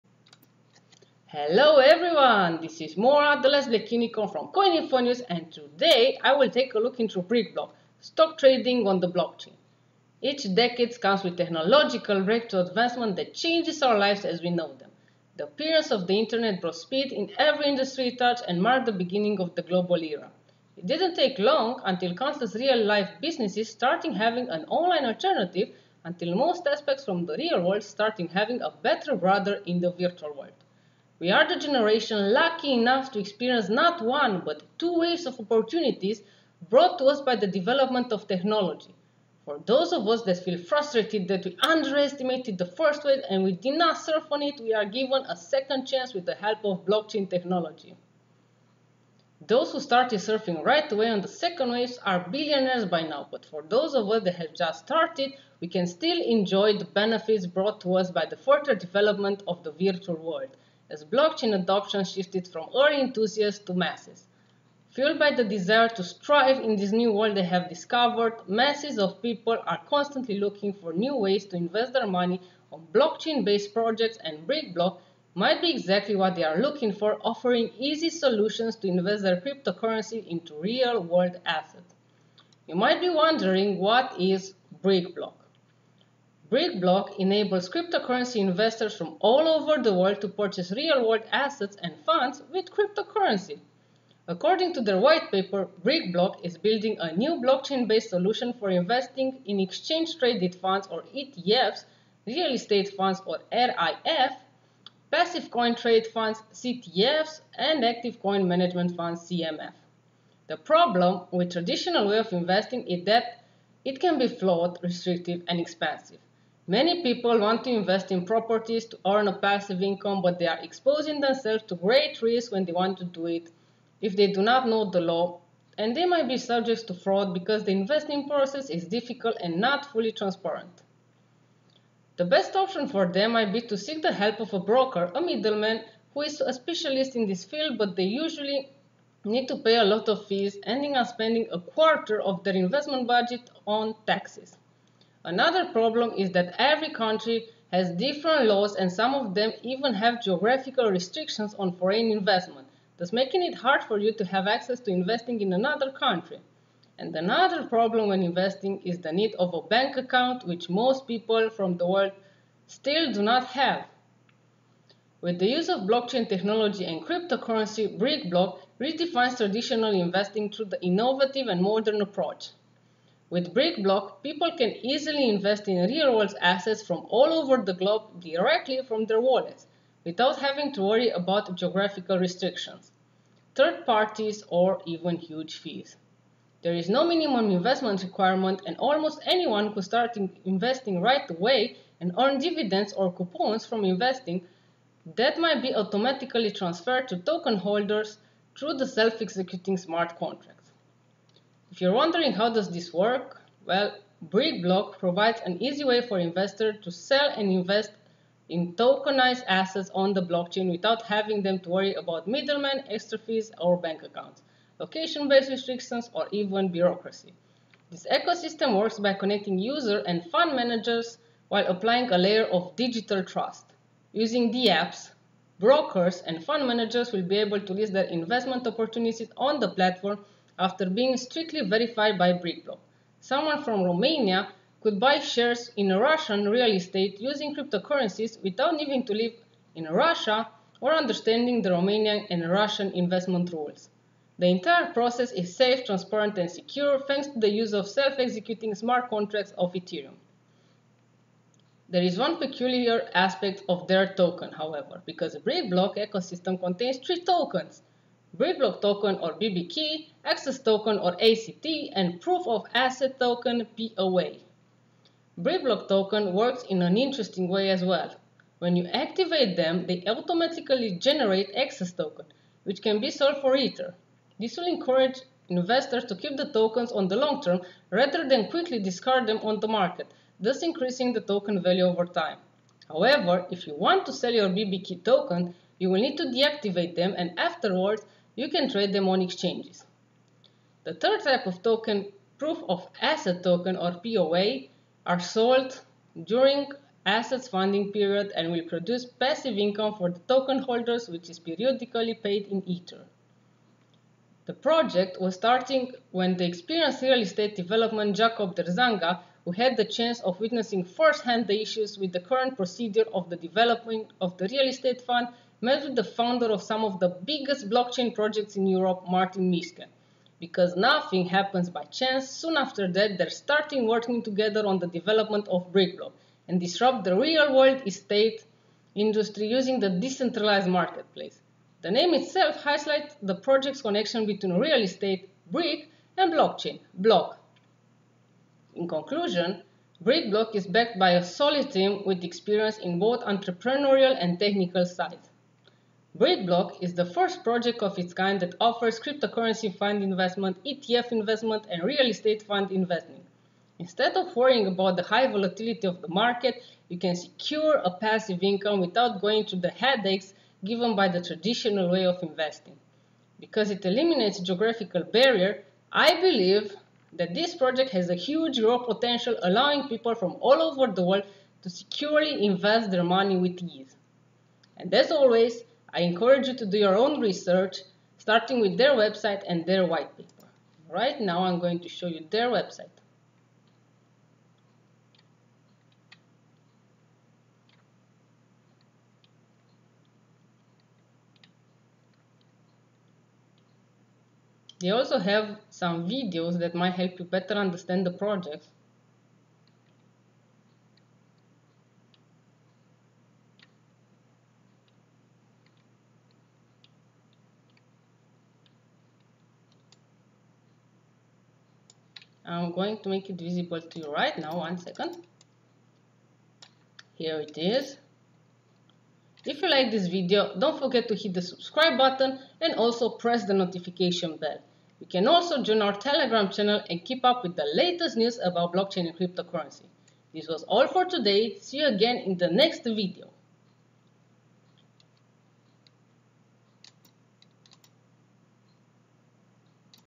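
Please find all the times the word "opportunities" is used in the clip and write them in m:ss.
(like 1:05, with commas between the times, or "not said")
0:35, 3:48.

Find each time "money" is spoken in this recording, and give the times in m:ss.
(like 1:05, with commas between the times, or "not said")
1:12, 6:13.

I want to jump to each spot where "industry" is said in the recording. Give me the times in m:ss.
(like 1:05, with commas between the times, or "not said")
0:17, 5:28.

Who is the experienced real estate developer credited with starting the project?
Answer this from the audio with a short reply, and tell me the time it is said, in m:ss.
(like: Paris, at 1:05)
Jacob Drzazga, at 5:08.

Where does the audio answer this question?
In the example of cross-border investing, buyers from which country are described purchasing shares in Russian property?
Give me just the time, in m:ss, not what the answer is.
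3:53.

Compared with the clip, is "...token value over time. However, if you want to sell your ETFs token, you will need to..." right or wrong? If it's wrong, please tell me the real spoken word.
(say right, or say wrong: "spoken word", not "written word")
wrong: "BBK", not "ETFs".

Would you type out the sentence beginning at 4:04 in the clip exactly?
The entire process is safe, transparent, and secure thanks to the use of self-executing smart contracts of Ethereum.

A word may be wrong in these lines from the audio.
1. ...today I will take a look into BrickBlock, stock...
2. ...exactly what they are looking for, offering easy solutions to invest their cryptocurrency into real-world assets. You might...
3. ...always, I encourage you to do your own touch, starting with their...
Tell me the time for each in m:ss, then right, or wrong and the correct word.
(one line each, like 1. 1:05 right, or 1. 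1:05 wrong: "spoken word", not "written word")
1. 0:05 right
2. 1:15 right
3. 6:15 wrong: "research", not "touch".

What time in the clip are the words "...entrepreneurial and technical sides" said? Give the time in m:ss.
5:43.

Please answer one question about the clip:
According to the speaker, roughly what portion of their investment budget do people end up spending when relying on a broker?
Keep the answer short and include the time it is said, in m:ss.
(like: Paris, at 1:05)
a quarter, at 2:21.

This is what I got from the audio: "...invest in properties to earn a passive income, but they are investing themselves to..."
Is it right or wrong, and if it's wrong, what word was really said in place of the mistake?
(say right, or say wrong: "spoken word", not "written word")
wrong: "exposing", not "investing".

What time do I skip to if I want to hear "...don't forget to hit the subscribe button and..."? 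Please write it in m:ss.
7:00.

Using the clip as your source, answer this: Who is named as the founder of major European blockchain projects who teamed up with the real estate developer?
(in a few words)
Martin Miske.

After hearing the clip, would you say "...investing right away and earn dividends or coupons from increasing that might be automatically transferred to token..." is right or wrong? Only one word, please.
wrong.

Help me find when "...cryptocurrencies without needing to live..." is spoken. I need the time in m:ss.
3:57.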